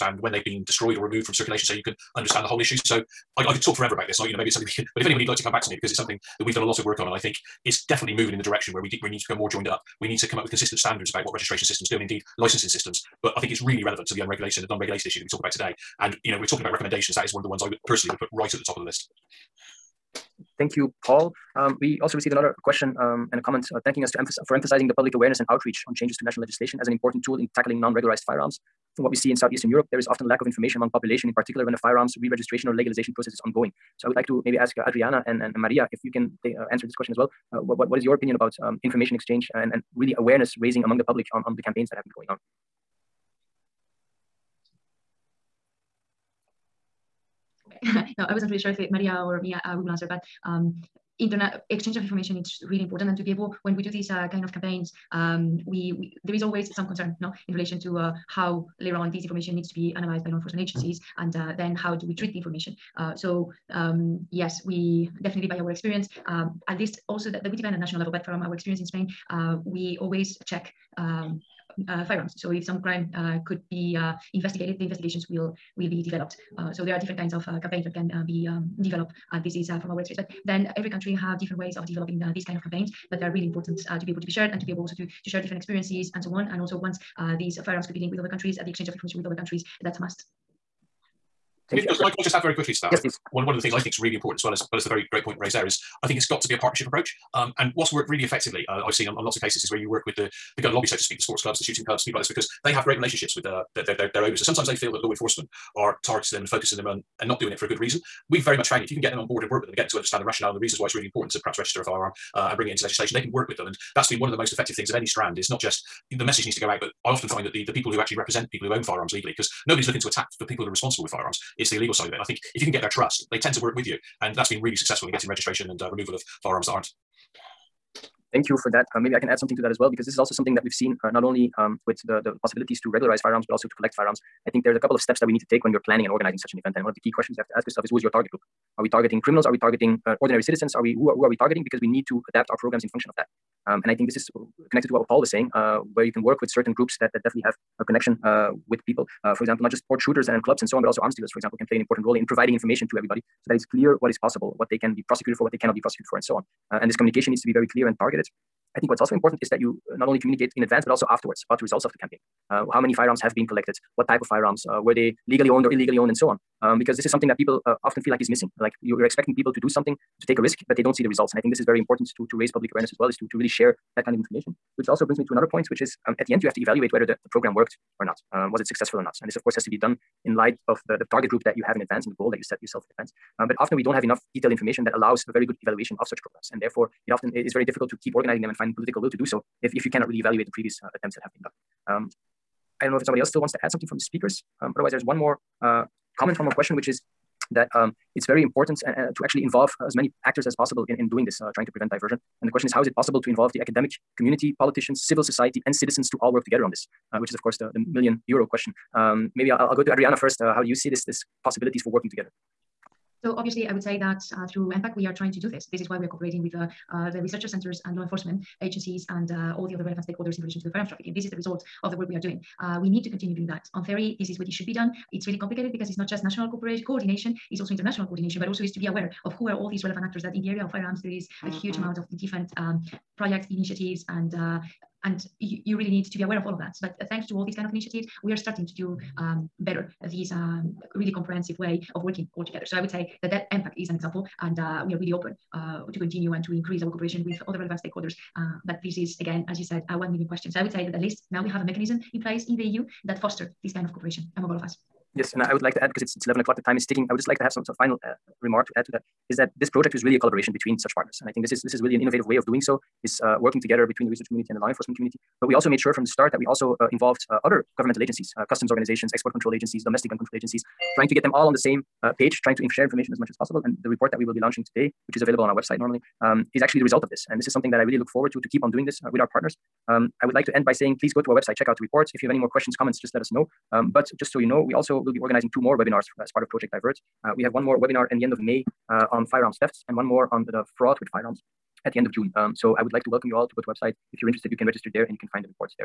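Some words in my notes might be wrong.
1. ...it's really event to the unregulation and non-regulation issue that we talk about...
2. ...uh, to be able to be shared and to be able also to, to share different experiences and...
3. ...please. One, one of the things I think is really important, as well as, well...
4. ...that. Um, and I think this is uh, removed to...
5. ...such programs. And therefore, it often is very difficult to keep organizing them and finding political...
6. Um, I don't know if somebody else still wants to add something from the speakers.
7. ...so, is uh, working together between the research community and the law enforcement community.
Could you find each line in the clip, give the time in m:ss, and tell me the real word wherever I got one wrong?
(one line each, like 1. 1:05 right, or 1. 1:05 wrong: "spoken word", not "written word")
1. 0:13 wrong: "relevant", not "event"
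2. 1:23 right
3. 1:33 right
4. 2:23 wrong: "connected", not "removed"
5. 3:06 right
6. 3:11 right
7. 4:22 right.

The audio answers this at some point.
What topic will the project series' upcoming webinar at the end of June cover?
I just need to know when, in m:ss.
4:50.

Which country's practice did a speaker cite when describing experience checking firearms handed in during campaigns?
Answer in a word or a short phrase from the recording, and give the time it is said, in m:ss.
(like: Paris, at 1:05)
Spain, at 1:08.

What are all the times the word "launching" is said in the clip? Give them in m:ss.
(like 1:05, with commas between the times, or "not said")
4:34.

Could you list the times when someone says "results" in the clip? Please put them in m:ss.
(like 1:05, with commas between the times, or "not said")
2:41, 2:51, 3:41, 4:36.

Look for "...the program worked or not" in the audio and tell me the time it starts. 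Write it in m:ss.
2:57.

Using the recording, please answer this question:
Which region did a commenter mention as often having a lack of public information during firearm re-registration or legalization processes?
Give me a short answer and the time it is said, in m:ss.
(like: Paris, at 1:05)
Southeastern Europe, at 0:29.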